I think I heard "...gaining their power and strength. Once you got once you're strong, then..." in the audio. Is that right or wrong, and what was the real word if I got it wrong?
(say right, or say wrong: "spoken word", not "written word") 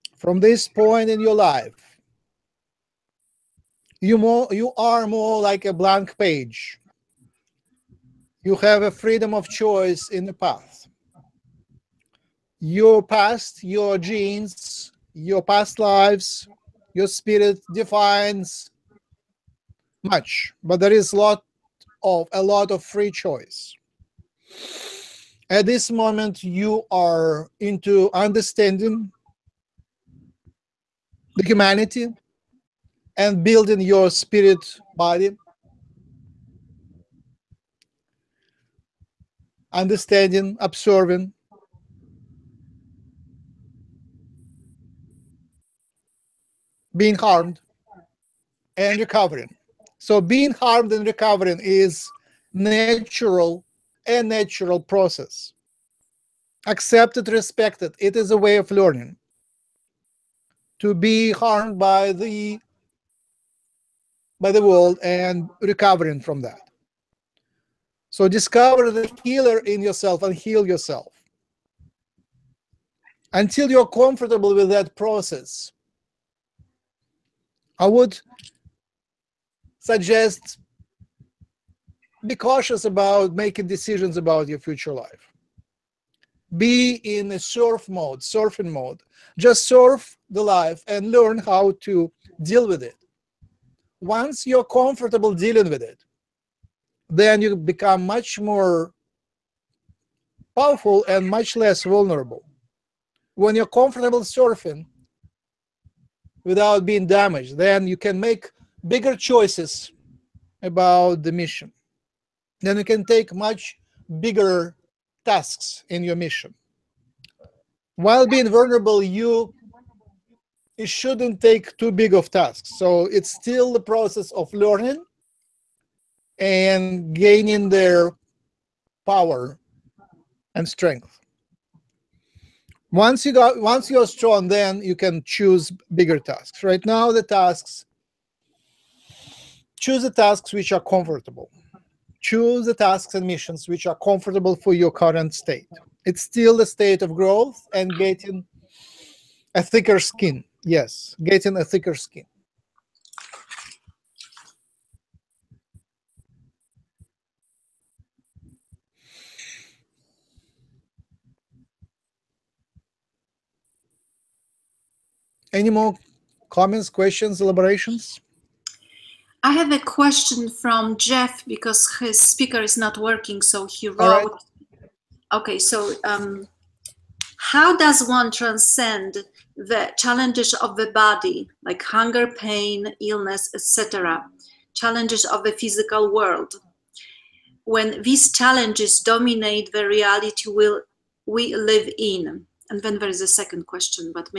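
right.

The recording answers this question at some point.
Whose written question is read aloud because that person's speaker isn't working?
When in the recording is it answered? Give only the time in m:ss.
2:50.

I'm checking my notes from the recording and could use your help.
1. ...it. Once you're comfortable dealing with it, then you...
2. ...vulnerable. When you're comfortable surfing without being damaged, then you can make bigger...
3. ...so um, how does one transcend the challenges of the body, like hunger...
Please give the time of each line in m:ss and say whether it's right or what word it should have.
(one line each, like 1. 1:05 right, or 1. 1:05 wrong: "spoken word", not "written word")
1. 1:32 right
2. 1:41 right
3. 2:55 right.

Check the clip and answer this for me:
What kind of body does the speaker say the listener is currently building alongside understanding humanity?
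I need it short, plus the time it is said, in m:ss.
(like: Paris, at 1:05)
Spirit body, at 0:34.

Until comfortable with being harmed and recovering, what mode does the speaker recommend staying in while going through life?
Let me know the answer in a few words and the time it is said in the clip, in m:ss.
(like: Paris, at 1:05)
Surfing mode, at 1:28.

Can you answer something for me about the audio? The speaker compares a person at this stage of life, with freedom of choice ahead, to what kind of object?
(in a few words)
A blank page.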